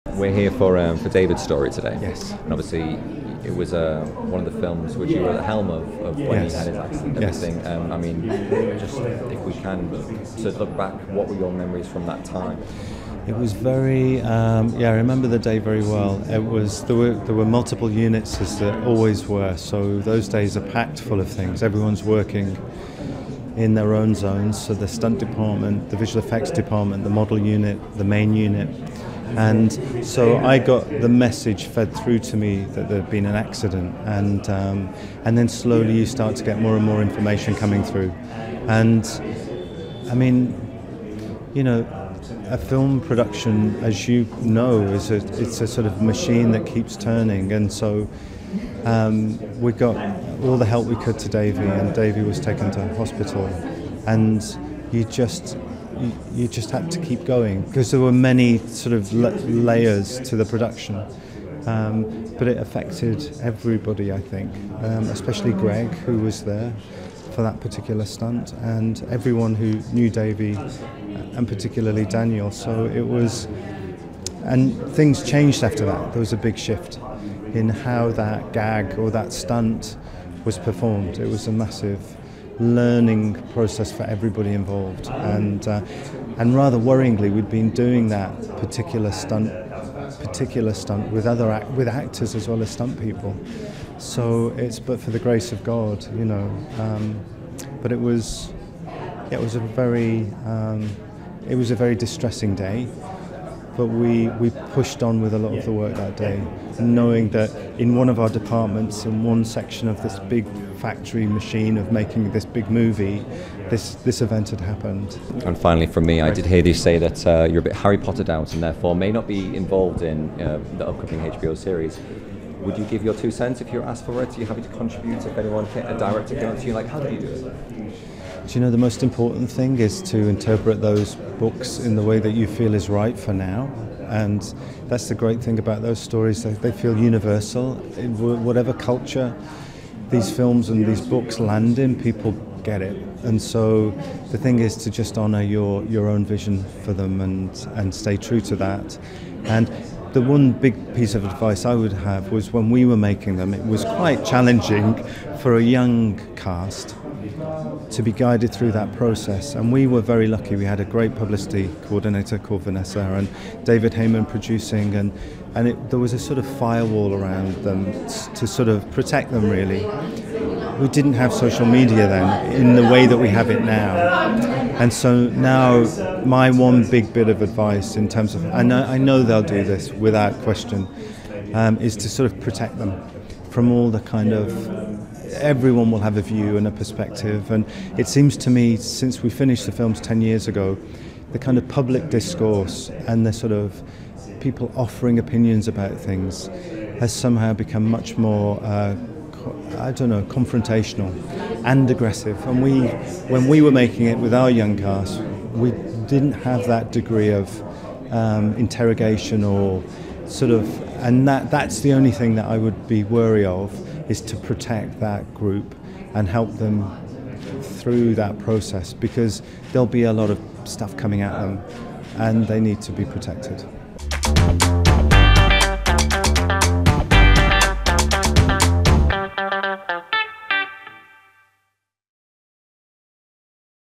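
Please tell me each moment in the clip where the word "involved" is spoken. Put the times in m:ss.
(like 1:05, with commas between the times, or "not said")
1:24, 1:59.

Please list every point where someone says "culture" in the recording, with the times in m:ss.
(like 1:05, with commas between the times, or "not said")
2:18.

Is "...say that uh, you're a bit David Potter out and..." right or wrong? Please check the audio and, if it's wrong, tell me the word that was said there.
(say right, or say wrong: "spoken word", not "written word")
wrong: "Harry", not "David".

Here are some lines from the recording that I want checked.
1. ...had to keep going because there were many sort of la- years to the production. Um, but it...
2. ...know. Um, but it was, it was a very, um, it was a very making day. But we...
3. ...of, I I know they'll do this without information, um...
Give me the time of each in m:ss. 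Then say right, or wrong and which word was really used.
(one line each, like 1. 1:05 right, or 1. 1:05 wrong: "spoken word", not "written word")
1. 0:56 wrong: "layers", not "years"
2. 1:36 wrong: "distressing", not "making"
3. 2:58 wrong: "question", not "information".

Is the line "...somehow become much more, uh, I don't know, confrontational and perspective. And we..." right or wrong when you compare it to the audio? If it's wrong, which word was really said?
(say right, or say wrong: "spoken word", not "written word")
wrong: "aggressive", not "perspective".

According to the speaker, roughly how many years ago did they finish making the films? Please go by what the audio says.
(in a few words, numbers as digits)
10 years.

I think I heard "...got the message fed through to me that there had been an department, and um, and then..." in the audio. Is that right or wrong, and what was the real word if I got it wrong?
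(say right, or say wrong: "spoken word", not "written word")
wrong: "accident", not "department".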